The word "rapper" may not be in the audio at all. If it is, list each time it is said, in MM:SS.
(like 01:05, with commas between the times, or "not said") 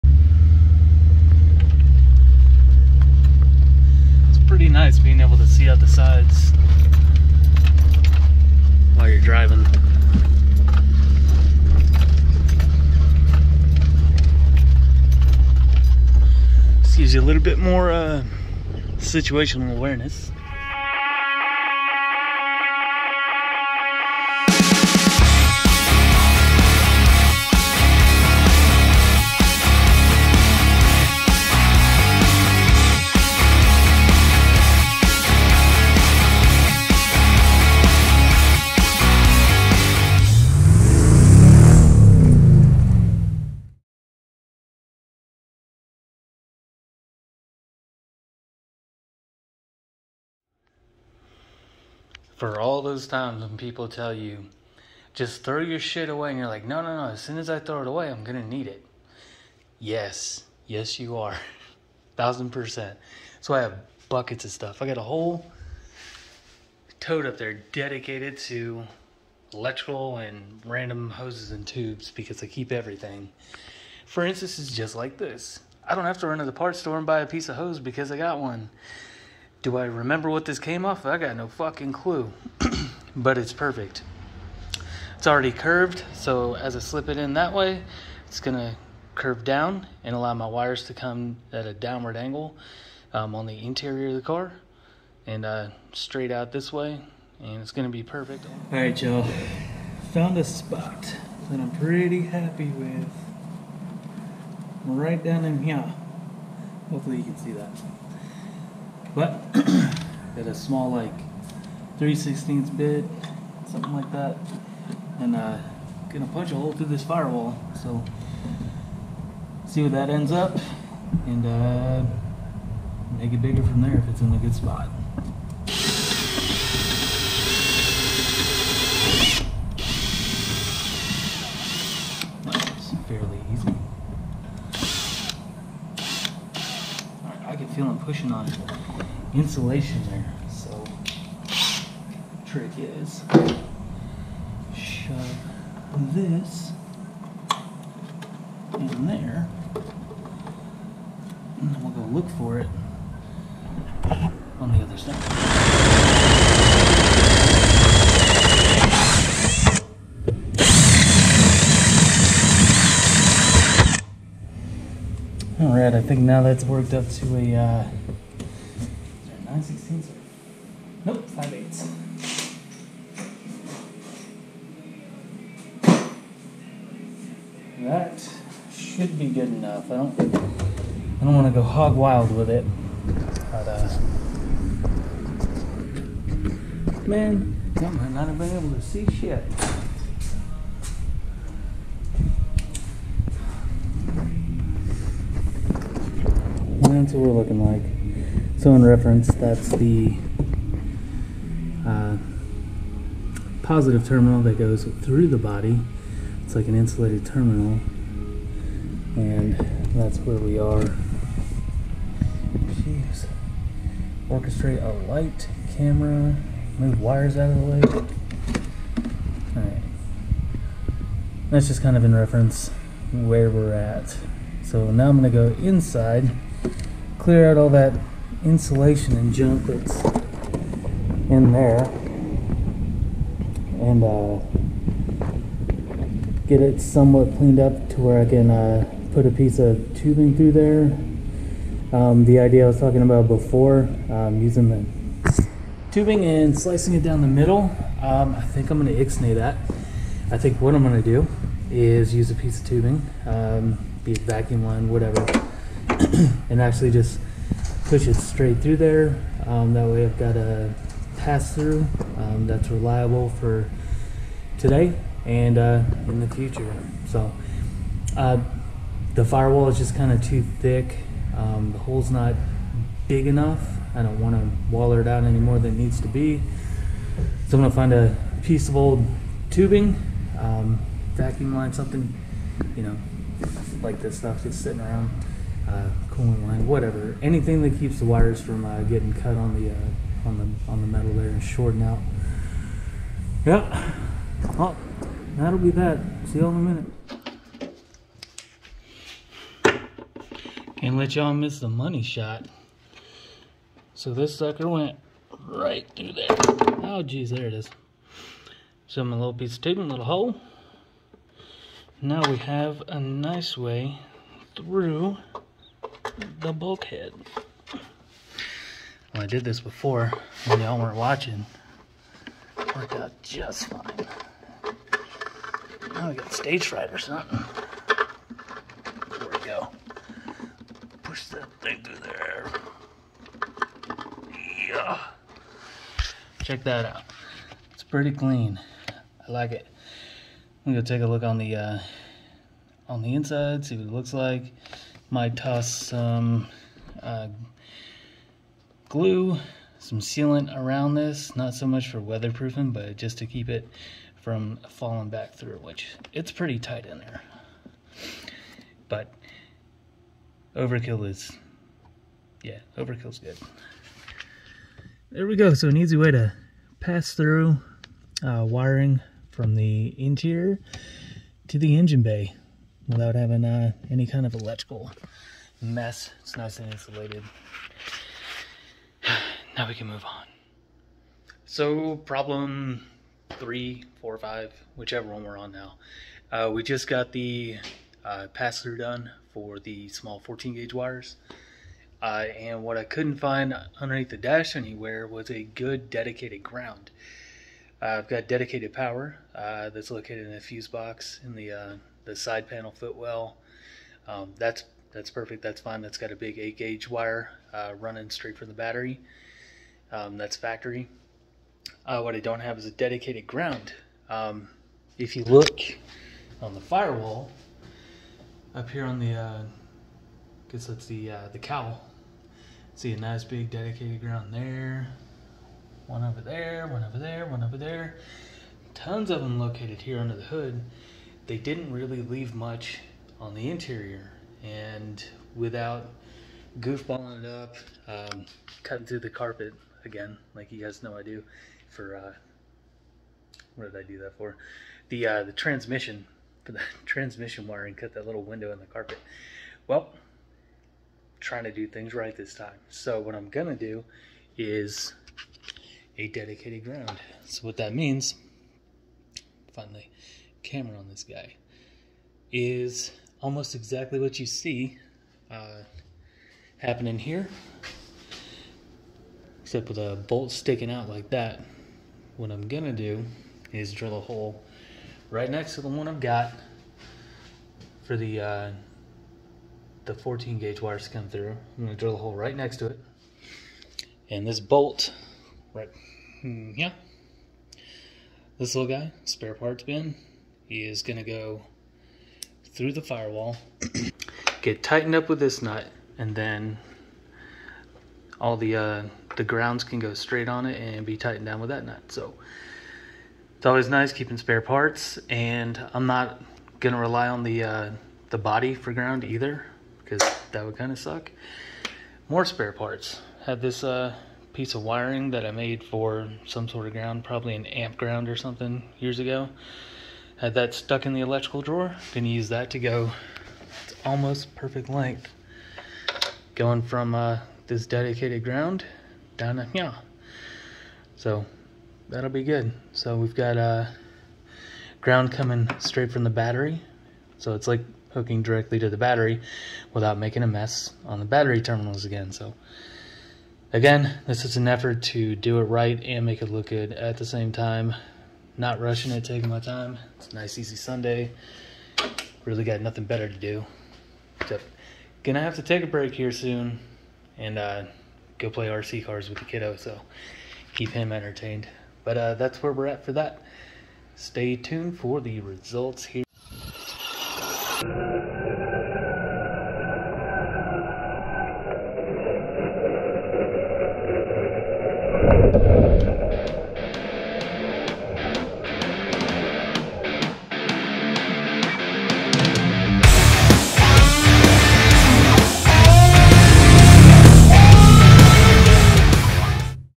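not said.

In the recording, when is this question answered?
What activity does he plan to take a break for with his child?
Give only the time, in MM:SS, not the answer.
09:18.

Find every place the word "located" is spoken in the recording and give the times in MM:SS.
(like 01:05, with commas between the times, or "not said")
06:39, 07:09.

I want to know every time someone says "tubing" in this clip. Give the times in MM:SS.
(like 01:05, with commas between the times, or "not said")
03:59, 04:05, 04:12, 04:39, 05:09.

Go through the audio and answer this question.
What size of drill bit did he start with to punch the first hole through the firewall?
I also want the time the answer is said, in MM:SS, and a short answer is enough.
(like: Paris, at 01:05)
3/16, at 01:51.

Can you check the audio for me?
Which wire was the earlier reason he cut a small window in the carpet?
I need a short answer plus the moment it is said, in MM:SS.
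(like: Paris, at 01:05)
Transmission wire, at 07:26.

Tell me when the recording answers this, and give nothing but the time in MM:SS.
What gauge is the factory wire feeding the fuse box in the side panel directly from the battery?
06:46.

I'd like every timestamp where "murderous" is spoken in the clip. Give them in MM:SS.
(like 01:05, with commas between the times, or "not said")
not said.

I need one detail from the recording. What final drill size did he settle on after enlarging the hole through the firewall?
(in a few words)
5/8.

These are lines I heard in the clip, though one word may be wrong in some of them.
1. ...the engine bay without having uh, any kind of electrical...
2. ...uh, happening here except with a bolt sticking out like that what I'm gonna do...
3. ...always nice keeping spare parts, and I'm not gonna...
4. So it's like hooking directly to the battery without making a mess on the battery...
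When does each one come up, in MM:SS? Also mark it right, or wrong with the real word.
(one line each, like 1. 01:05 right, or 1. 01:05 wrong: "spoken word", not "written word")
1. 06:11 right
2. 07:45 right
3. 08:23 right
4. 08:57 right.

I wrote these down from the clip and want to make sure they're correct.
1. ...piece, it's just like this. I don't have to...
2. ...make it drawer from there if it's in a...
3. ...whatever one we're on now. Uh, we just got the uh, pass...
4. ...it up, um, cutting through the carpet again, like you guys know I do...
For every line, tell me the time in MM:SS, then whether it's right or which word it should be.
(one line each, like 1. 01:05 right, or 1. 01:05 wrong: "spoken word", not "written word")
1. 01:14 wrong: "instance", not "piece"
2. 02:03 wrong: "bigger", not "drawer"
3. 06:24 wrong: "whichever", not "whatever"
4. 07:17 right.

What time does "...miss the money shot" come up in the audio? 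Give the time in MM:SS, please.
05:01.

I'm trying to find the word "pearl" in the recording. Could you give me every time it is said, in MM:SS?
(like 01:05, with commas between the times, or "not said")
not said.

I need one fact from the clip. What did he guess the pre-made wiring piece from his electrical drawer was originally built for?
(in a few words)
Amp ground.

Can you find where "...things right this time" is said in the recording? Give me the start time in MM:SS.
07:31.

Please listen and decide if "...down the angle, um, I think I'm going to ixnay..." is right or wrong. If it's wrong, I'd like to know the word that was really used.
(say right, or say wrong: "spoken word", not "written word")
wrong: "middle", not "angle".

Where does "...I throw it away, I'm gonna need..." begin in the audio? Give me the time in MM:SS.
00:57.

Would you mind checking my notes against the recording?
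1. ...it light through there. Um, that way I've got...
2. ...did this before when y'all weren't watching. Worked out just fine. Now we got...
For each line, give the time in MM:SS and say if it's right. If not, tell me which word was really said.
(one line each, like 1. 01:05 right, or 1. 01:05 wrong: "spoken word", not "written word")
1. 04:18 wrong: "straight", not "light"
2. 05:19 right.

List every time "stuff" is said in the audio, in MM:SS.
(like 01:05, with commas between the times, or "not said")
01:04, 04:44.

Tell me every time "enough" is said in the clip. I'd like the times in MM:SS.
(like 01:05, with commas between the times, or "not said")
02:59, 04:33.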